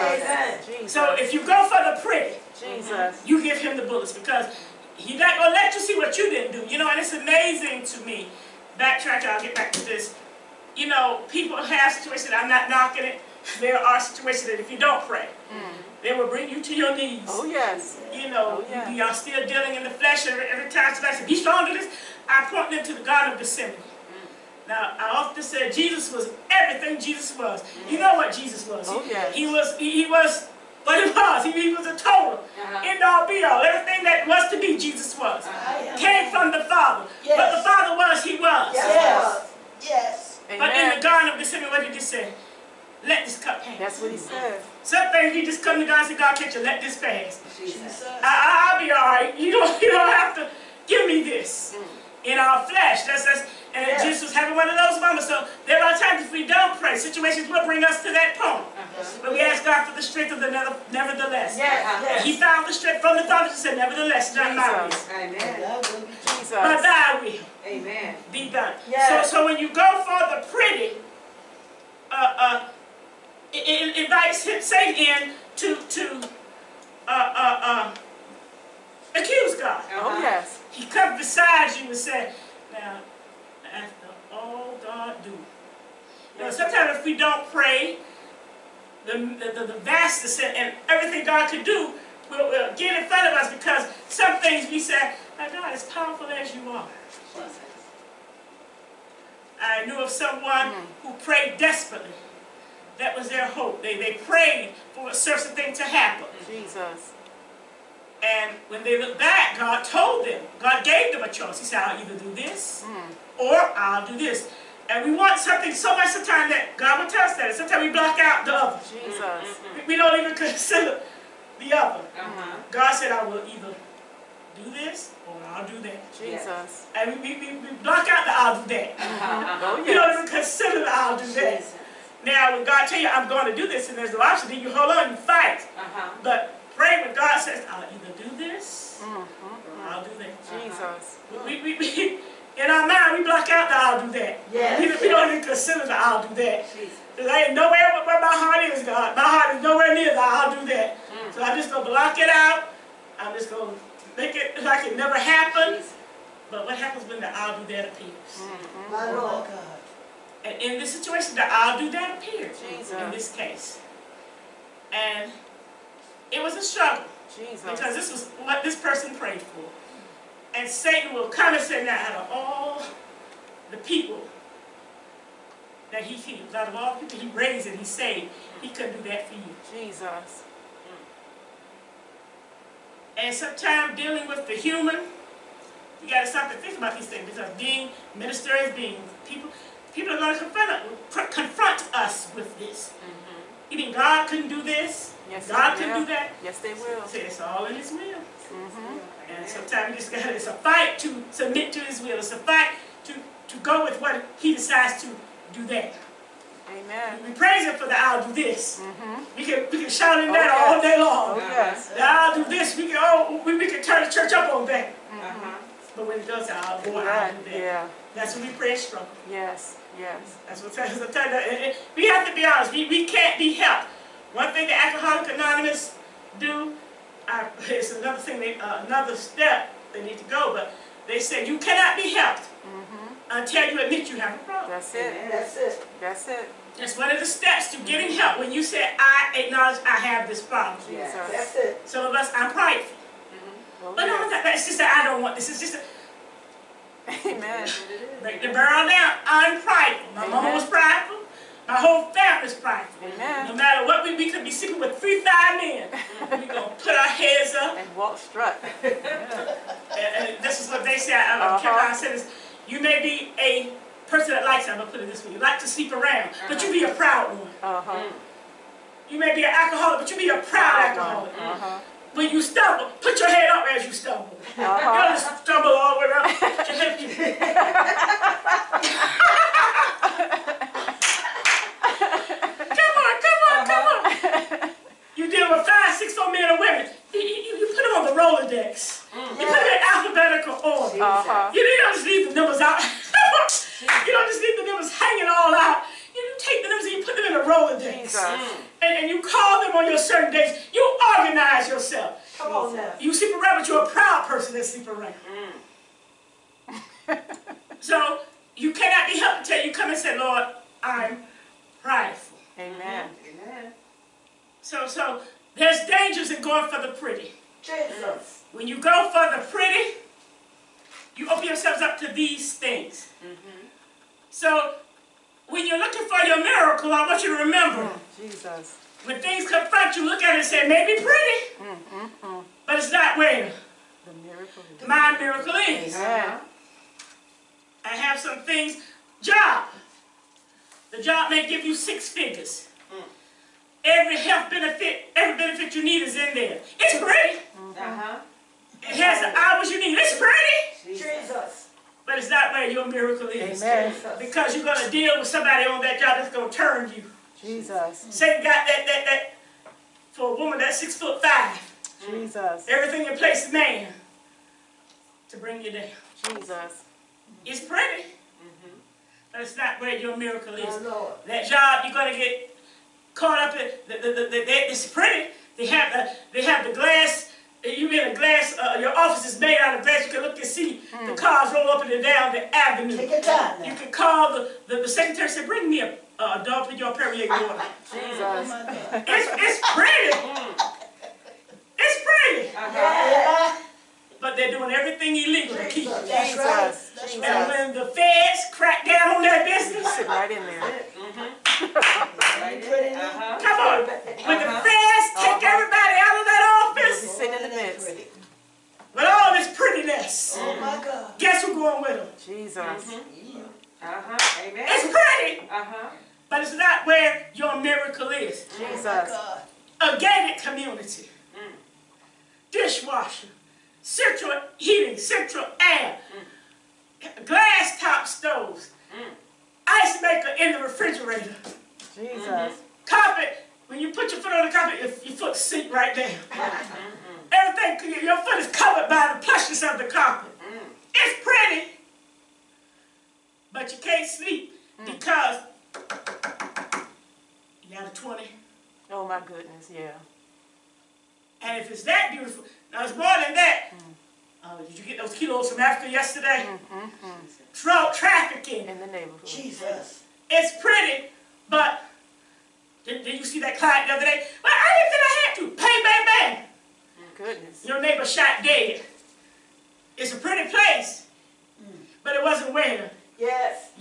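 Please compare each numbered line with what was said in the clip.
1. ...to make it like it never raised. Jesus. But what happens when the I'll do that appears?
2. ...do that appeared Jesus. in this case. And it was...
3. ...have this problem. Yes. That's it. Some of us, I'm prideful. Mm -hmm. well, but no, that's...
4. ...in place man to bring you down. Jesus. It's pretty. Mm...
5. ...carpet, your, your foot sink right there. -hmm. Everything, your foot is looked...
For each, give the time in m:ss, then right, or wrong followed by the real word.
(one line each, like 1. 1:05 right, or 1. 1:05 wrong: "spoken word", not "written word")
1. 2:33 wrong: "happened", not "raised"
2. 2:41 right
3. 4:00 right
4. 6:03 right
5. 7:14 wrong: "covered", not "looked".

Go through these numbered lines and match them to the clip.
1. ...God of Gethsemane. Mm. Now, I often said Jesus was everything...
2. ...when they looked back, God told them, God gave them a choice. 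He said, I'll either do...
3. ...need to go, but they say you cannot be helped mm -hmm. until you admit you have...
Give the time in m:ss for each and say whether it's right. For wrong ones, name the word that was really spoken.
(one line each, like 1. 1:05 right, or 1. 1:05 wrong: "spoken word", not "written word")
1. 0:23 right
2. 1:48 right
3. 3:50 right.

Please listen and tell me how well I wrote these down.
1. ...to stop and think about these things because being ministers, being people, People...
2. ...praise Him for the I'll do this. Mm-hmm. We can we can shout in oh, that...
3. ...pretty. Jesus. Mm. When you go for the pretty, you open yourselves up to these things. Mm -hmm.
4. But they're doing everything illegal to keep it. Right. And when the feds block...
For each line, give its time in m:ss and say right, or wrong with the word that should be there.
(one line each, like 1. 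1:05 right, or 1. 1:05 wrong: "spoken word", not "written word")
1. 3:06 right
2. 3:27 right
3. 5:16 right
4. 6:34 wrong: "crack", not "block".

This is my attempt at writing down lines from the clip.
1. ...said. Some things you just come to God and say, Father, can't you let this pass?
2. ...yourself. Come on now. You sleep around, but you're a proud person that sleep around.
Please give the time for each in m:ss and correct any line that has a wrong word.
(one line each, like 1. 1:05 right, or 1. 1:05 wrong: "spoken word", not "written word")
1. 0:44 wrong: "God", not "Father"
2. 5:01 right.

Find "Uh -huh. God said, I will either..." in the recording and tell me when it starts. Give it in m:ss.
2:01.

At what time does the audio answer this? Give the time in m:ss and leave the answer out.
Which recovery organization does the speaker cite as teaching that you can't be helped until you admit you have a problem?
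3:44.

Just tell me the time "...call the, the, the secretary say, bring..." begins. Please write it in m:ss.
6:23.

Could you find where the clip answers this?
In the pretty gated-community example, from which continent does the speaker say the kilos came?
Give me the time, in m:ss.
7:35.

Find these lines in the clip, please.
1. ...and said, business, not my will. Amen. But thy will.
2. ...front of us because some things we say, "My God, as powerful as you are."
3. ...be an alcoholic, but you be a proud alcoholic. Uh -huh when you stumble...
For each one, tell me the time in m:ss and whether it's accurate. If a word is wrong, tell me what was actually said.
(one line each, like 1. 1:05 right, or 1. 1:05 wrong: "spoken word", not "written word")
1. 1:03 wrong: "nevertheless", not "business"
2. 1:33 right
3. 4:29 right.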